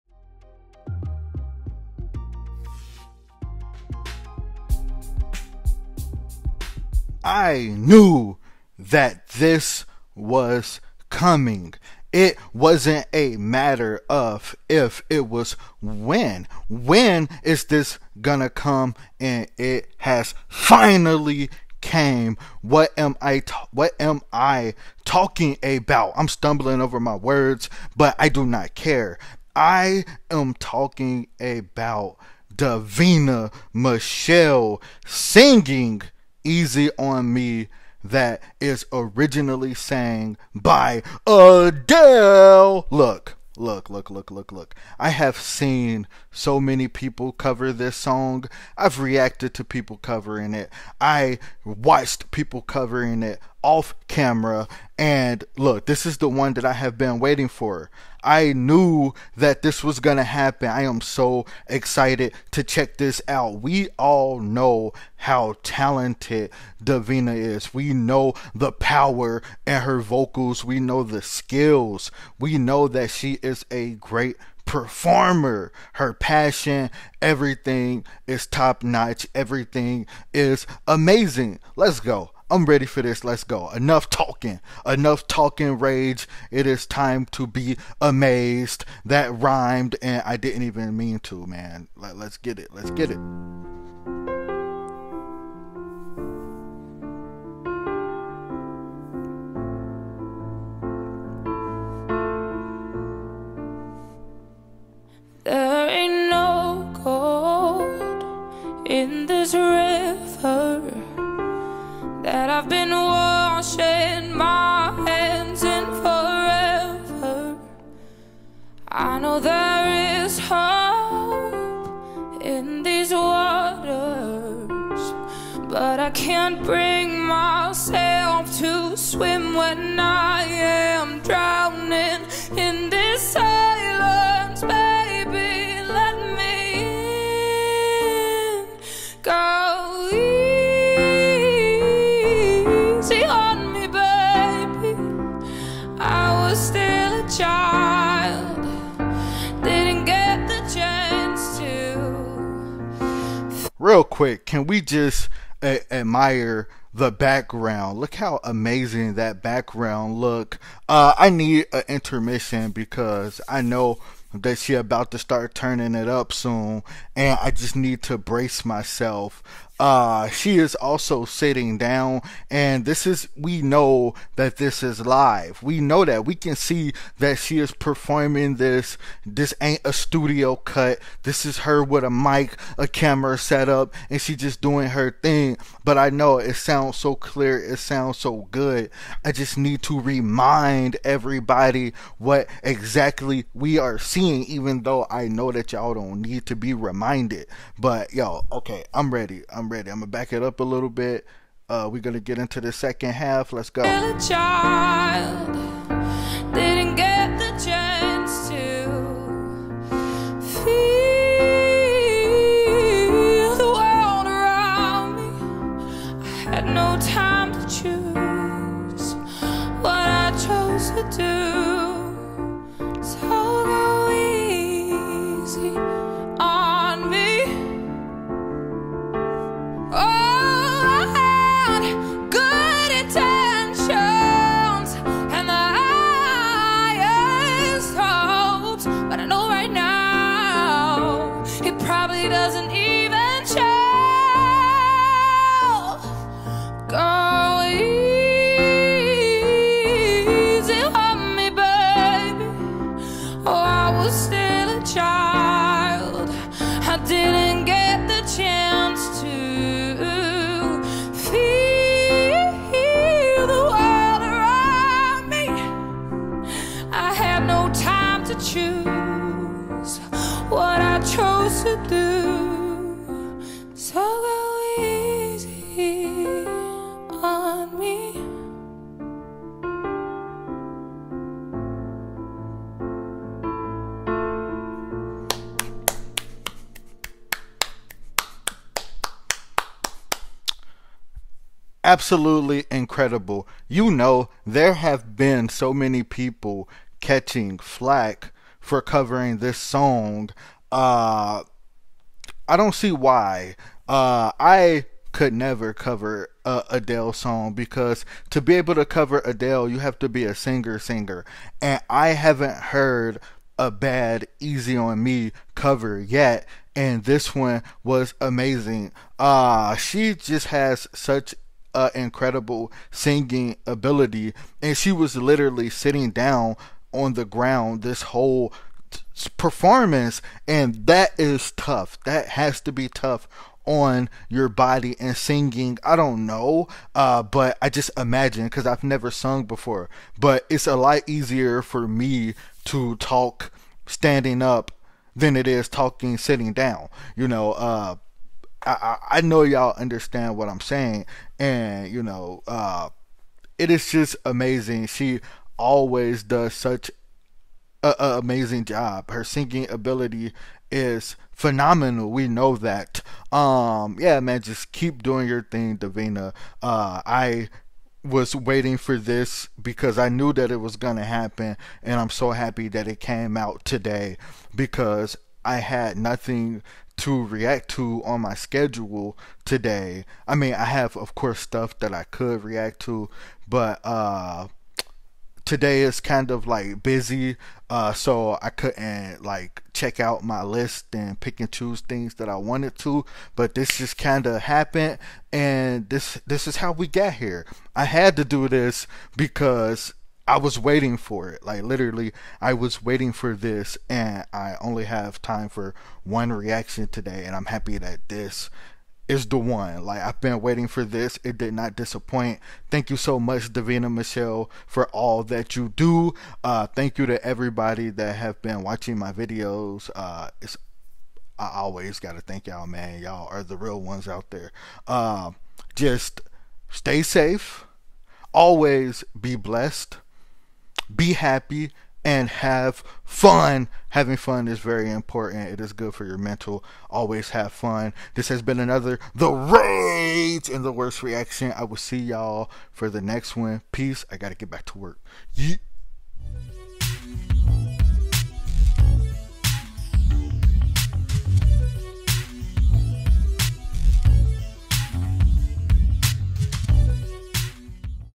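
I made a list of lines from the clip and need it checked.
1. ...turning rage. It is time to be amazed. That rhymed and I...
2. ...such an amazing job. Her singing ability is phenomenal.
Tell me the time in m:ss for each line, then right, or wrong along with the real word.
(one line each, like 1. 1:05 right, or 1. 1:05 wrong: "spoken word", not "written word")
1. 1:25 wrong: "talking", not "turning"
2. 5:56 right.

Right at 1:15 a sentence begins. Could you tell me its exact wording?
Her passion, everything is top notch.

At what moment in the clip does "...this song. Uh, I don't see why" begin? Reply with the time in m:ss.
4:59.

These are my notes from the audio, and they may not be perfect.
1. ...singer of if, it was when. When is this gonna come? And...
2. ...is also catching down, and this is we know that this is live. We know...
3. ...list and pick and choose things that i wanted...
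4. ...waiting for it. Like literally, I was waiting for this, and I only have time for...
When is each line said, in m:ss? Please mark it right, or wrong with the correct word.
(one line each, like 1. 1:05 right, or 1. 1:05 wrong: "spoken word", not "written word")
1. 0:13 wrong: "matter", not "singer"
2. 2:50 wrong: "sitting", not "catching"
3. 6:30 right
4. 6:40 right.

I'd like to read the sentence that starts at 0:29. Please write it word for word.
I am talking about Davina Michelle singing Easy on Me that is originally sang by Adele.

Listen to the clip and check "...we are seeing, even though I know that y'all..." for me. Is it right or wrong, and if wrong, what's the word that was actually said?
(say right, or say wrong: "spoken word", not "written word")
right.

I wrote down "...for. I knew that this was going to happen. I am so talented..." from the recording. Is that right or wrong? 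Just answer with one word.
wrong.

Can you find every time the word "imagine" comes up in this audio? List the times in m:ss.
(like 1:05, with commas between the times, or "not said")
5:37.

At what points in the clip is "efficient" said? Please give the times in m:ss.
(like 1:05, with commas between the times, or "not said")
not said.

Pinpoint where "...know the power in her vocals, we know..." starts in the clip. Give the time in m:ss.
1:07.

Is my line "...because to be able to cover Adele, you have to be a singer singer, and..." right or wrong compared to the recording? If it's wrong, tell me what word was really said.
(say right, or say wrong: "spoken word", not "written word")
right.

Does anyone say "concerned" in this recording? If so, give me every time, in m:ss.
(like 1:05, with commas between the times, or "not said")
not said.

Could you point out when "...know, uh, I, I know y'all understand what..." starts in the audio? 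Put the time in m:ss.
5:47.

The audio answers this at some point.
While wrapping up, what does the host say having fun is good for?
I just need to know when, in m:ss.
7:16.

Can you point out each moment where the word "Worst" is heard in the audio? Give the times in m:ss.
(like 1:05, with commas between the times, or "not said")
7:20.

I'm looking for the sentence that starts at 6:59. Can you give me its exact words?
Uh, it's I always gotta thank y'all, man.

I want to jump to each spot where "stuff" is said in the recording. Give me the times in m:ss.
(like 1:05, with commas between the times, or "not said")
6:21.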